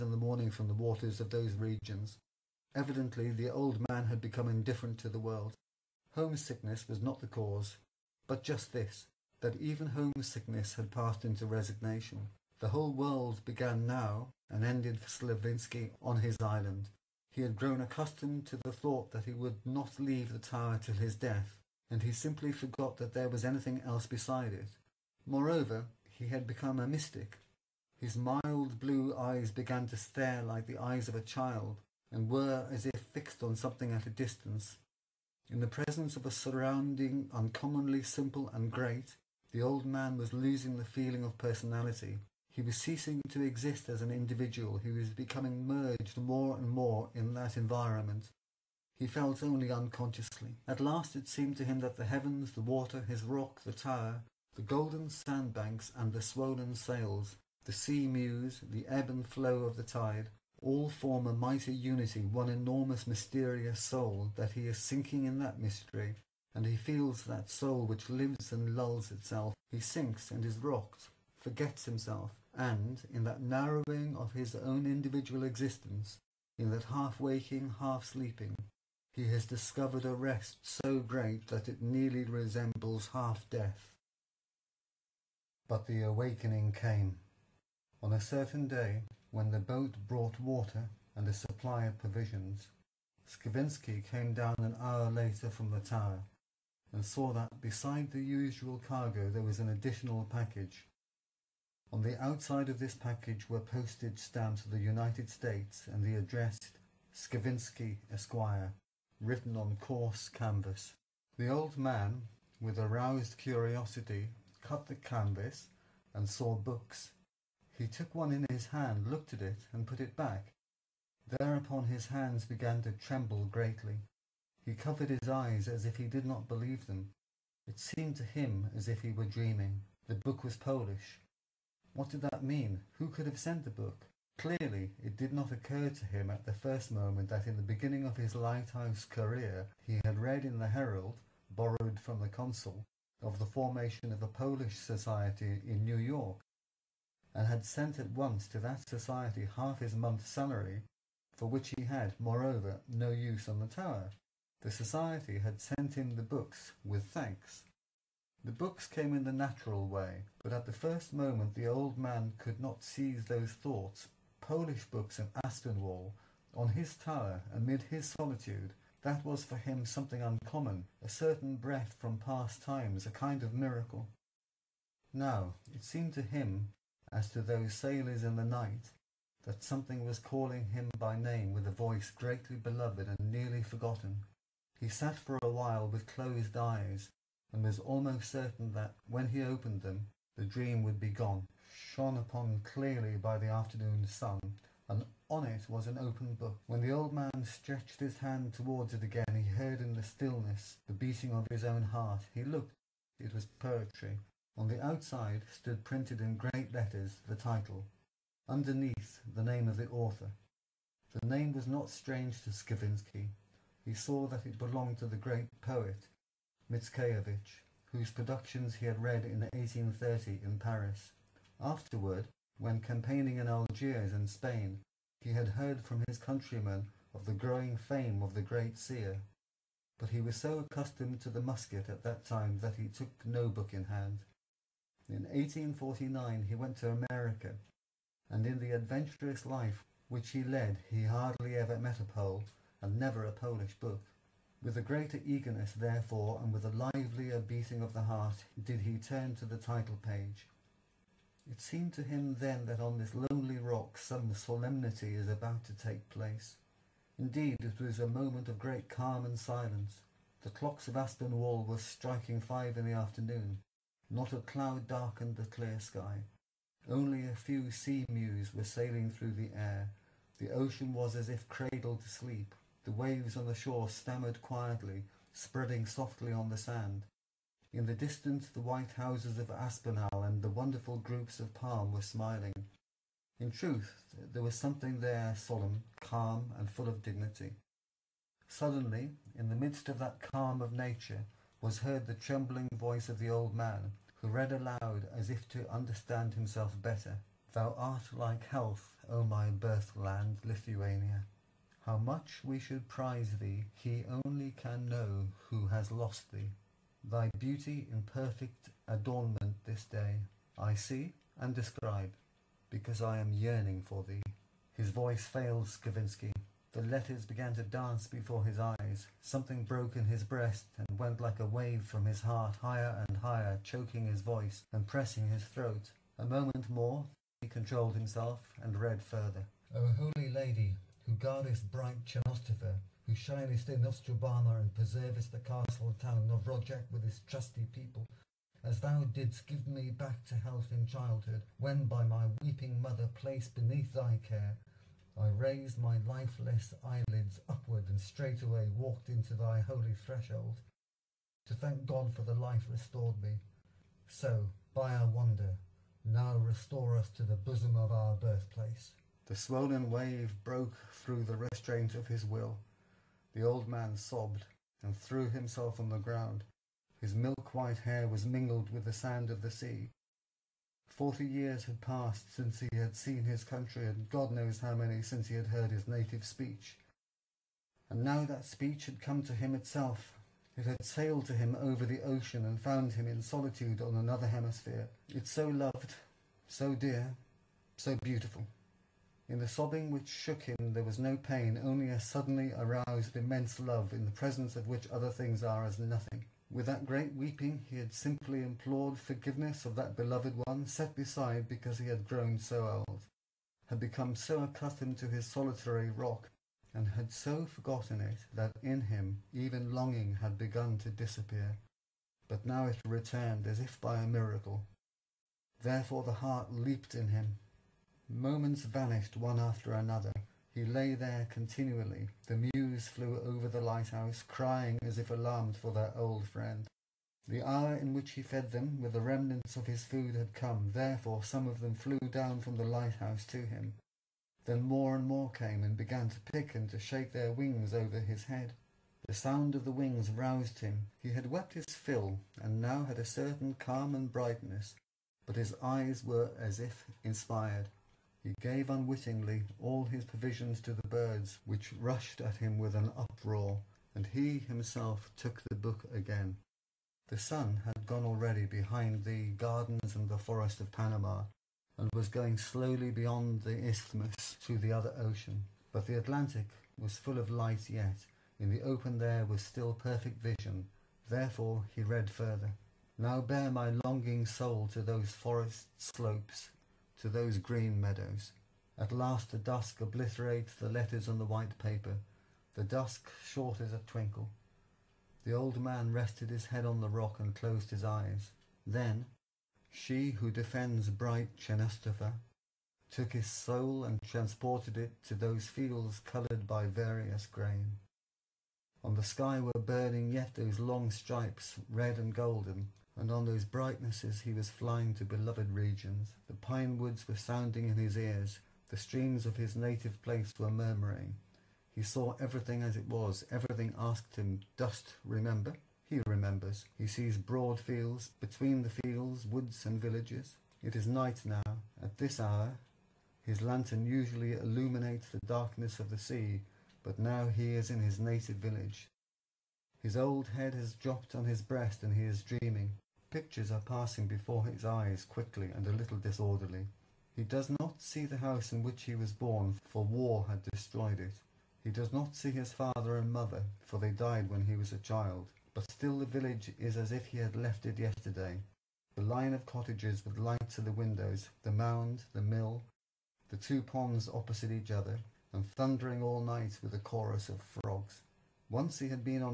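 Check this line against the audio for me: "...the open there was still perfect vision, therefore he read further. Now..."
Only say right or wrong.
right.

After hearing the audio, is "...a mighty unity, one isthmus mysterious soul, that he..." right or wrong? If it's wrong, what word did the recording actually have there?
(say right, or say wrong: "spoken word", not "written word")
wrong: "enormous", not "isthmus".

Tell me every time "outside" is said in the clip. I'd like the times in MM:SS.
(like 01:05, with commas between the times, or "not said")
01:42, 03:24.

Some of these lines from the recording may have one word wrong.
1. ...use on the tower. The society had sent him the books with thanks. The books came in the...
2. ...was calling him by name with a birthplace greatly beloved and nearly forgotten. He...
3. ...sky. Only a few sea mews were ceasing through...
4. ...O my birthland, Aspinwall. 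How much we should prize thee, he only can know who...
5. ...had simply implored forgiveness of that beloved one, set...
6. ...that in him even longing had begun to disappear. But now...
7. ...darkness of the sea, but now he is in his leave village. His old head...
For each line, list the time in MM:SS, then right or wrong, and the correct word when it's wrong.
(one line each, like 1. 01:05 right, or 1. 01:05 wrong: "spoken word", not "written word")
1. 02:33 right
2. 03:00 wrong: "voice", not "birthplace"
3. 04:25 wrong: "sailing", not "ceasing"
4. 04:59 wrong: "Lithuania", not "Aspinwall"
5. 06:37 right
6. 06:48 right
7. 08:45 wrong: "native", not "leave".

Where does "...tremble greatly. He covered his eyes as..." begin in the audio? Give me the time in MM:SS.
02:02.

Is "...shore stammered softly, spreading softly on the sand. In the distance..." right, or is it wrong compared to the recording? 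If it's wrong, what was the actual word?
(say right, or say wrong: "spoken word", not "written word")
wrong: "quietly", not "softly".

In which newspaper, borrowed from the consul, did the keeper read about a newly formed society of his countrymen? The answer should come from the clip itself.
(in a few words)
Herald.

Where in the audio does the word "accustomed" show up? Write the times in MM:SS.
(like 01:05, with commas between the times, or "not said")
00:17, 03:50, 06:44.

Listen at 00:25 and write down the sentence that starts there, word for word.
Moreover, he had become a mystic.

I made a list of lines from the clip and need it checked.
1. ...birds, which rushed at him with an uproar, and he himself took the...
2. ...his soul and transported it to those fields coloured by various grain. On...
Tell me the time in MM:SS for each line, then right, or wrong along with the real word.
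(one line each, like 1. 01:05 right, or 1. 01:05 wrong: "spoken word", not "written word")
1. 07:30 right
2. 08:13 right.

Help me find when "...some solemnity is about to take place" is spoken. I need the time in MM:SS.
04:13.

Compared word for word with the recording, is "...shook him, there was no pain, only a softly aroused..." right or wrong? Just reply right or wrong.
wrong.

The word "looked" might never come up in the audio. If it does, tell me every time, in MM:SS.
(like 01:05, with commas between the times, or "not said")
01:59, 03:22.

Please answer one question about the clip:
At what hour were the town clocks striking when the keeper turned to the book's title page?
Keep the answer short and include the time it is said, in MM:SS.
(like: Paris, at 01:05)
five, at 04:22.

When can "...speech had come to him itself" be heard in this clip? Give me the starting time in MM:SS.
06:18.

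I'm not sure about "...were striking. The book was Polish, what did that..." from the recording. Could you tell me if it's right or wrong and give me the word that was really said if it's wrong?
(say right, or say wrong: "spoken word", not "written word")
wrong: "dreaming", not "striking".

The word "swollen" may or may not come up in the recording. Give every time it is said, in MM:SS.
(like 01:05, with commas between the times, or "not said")
00:56, 05:59.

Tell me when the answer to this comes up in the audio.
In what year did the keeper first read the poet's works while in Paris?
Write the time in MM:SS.
03:39.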